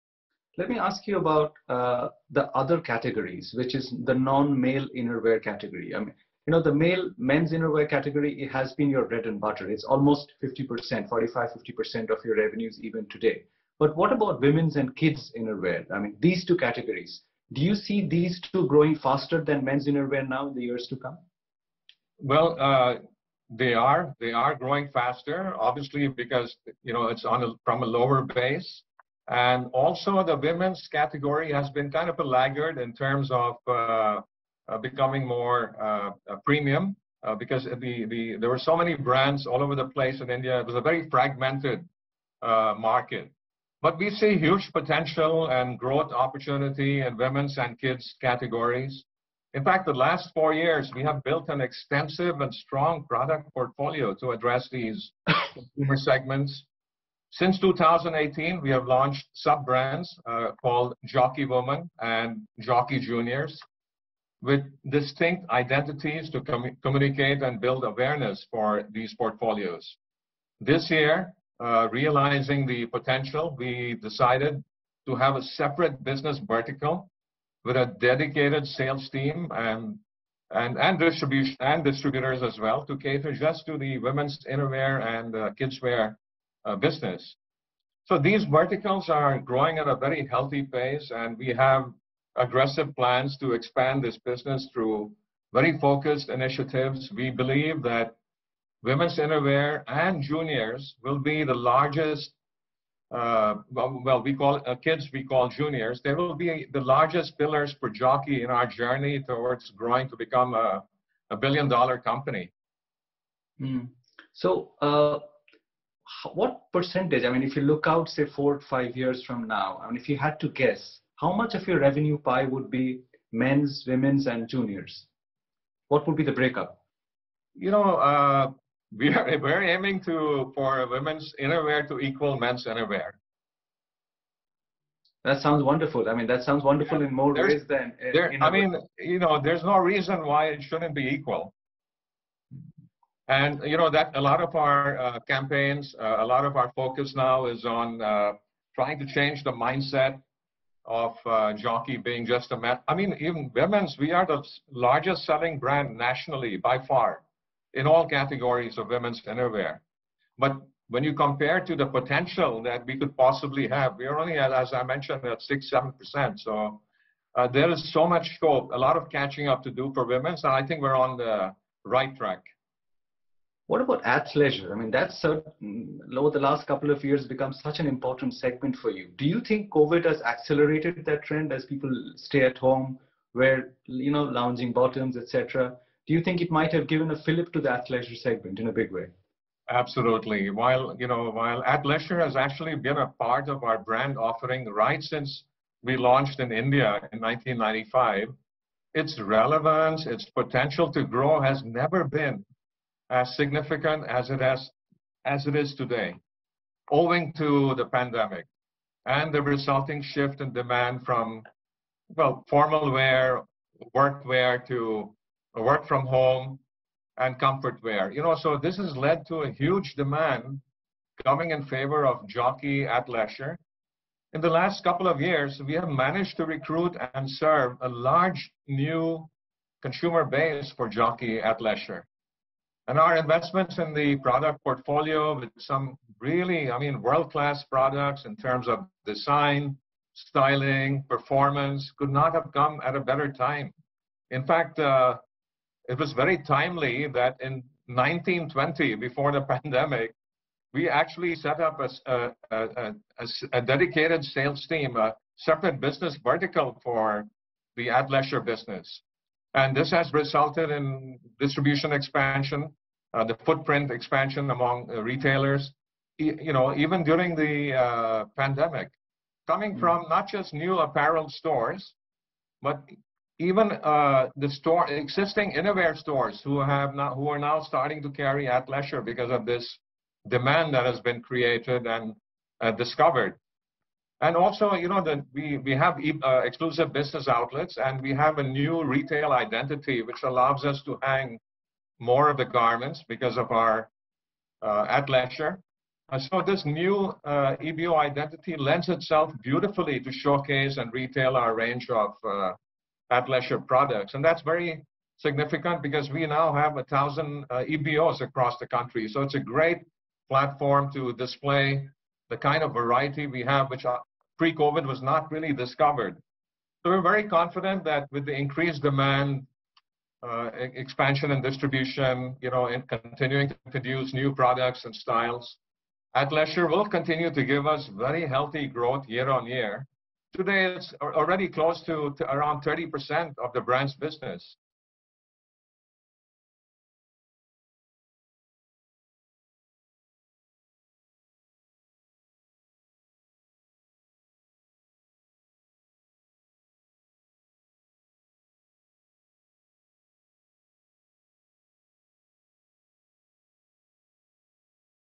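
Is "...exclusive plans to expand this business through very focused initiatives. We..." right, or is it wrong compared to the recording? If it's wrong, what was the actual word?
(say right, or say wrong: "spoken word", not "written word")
wrong: "aggressive", not "exclusive".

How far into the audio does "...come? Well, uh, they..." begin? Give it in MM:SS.
00:20.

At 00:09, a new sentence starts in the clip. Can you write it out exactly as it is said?
It's almost 50%, 45, 50% of your revenues even today.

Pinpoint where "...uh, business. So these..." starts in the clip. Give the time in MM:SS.
01:26.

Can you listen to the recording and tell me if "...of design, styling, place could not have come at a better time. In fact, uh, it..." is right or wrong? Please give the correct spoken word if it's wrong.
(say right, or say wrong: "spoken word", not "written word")
wrong: "performance", not "place".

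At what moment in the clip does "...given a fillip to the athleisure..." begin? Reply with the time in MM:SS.
03:06.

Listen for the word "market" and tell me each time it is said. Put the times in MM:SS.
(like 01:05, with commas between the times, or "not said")
00:42.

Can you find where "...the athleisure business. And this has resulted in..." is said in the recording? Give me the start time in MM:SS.
04:17.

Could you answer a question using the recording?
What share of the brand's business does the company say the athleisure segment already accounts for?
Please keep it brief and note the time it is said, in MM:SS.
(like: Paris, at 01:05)
around 30%, at 05:32.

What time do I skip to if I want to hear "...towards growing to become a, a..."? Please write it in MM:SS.
01:49.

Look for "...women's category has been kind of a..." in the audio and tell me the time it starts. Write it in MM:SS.
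00:30.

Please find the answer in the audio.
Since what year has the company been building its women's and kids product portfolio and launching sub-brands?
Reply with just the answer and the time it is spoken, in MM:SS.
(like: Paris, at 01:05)
2018, at 00:57.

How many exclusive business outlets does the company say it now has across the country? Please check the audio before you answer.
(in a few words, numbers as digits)
1,000.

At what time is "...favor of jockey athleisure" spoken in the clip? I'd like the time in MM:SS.
03:41.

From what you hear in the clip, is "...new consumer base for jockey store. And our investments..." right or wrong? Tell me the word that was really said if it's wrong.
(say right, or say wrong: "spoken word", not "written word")
wrong: "athleisure", not "store".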